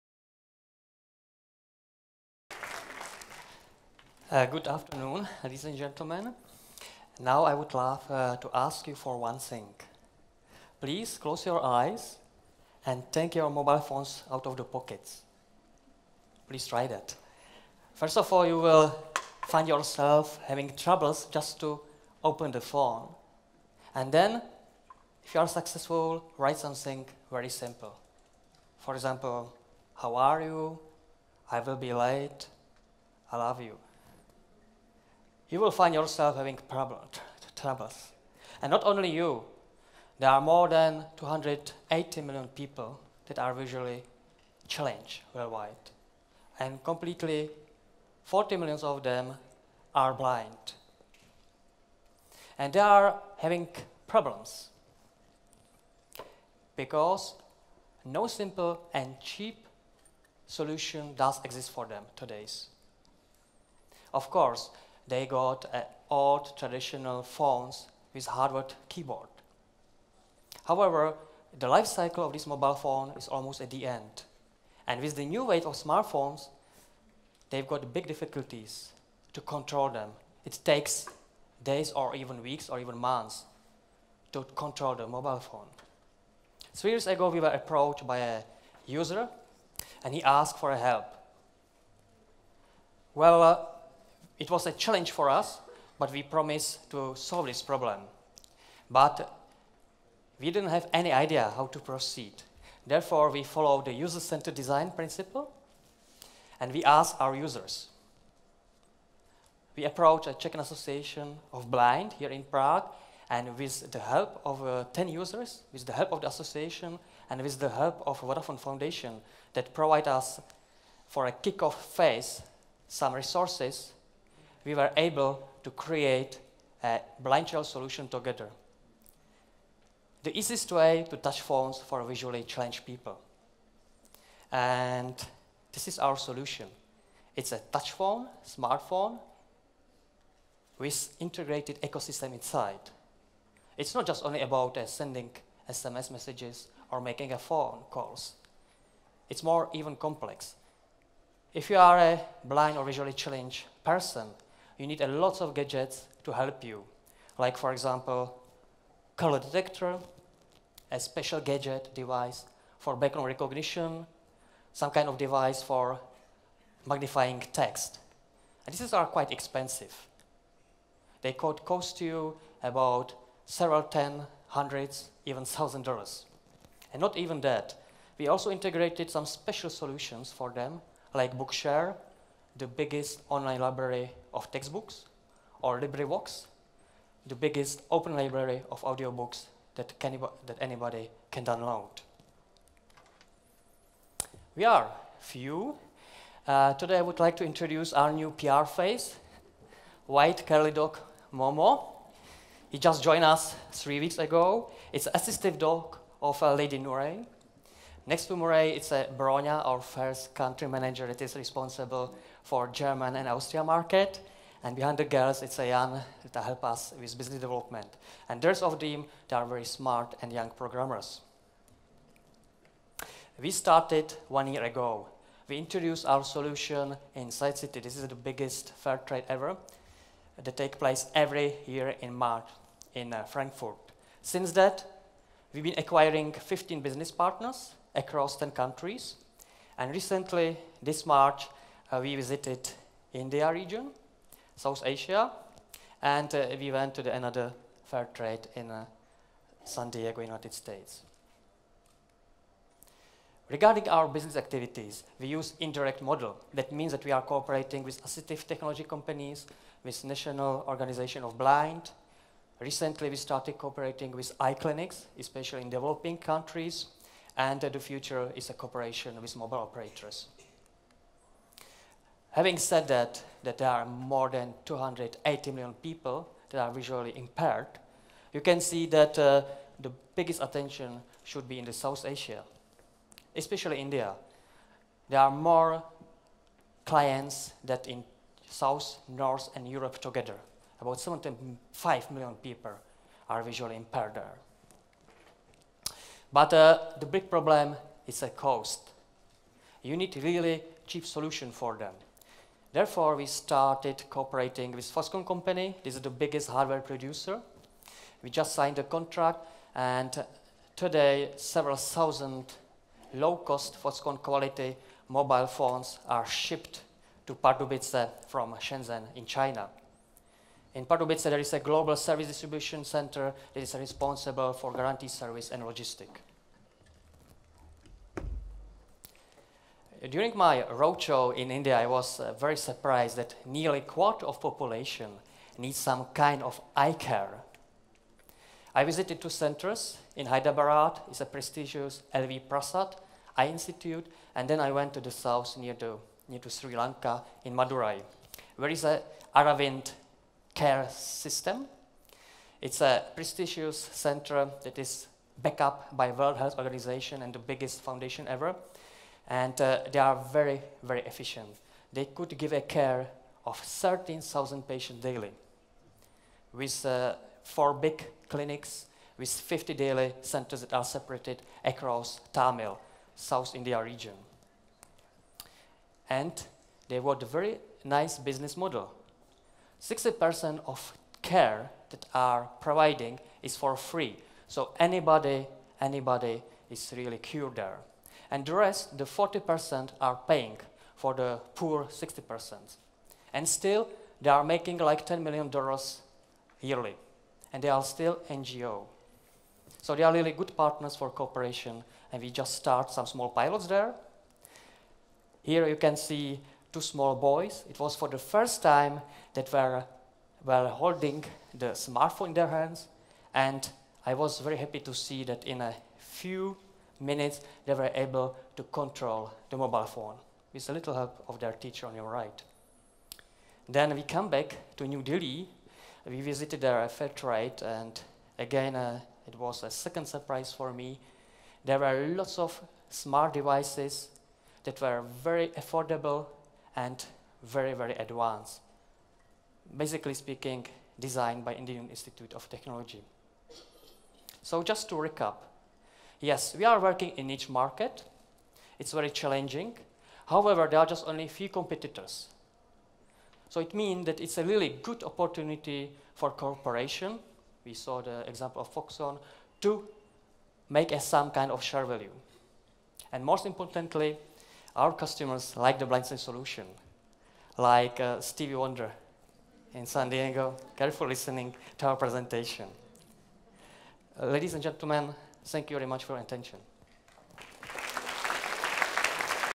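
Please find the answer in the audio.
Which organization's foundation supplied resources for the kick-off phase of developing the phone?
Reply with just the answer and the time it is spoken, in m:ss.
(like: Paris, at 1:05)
Vodafone Foundation, at 1:58.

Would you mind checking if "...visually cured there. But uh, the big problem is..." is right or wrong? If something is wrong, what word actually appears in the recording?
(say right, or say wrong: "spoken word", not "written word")
wrong: "impaired", not "cured".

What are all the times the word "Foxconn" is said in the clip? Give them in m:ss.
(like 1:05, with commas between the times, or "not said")
5:04, 5:13, 7:38.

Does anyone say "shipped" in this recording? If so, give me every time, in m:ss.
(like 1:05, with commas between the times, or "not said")
5:16.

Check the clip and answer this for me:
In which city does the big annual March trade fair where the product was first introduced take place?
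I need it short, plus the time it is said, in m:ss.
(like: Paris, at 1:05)
Frankfurt, at 3:53.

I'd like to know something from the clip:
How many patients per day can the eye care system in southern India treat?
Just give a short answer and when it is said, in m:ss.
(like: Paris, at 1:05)
13,000, at 6:03.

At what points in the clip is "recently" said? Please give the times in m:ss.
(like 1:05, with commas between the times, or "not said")
3:59, 4:22.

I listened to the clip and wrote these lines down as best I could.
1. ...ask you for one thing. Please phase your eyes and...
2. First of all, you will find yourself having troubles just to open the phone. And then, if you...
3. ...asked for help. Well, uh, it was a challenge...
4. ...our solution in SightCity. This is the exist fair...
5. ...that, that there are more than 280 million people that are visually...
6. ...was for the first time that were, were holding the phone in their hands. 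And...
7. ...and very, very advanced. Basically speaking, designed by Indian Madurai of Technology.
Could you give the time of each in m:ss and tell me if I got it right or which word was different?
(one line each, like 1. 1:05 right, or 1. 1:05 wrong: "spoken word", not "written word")
1. 0:08 wrong: "close", not "phase"
2. 0:17 right
3. 1:30 right
4. 3:46 wrong: "biggest", not "exist"
5. 4:32 right
6. 6:47 wrong: "smartphone", not "phone"
7. 7:16 wrong: "Institute", not "Madurai".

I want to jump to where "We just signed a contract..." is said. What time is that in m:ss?
5:08.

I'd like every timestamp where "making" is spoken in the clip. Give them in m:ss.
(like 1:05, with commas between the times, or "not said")
2:27, 6:34.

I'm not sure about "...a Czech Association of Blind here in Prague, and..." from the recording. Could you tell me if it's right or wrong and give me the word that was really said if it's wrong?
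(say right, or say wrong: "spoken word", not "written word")
right.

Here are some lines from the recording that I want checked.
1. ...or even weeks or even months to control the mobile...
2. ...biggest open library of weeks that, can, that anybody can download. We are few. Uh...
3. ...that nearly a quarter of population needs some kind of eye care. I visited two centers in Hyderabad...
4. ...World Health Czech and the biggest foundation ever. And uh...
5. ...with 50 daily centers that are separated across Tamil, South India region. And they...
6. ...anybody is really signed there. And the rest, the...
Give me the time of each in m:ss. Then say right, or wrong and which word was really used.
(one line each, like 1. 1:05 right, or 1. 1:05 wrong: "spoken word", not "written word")
1. 1:21 right
2. 3:07 wrong: "audiobooks", not "weeks"
3. 5:33 right
4. 5:56 wrong: "Organization", not "Czech"
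5. 6:09 right
6. 6:25 wrong: "cured", not "signed".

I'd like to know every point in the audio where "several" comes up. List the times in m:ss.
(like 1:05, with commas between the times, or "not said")
2:53, 5:11.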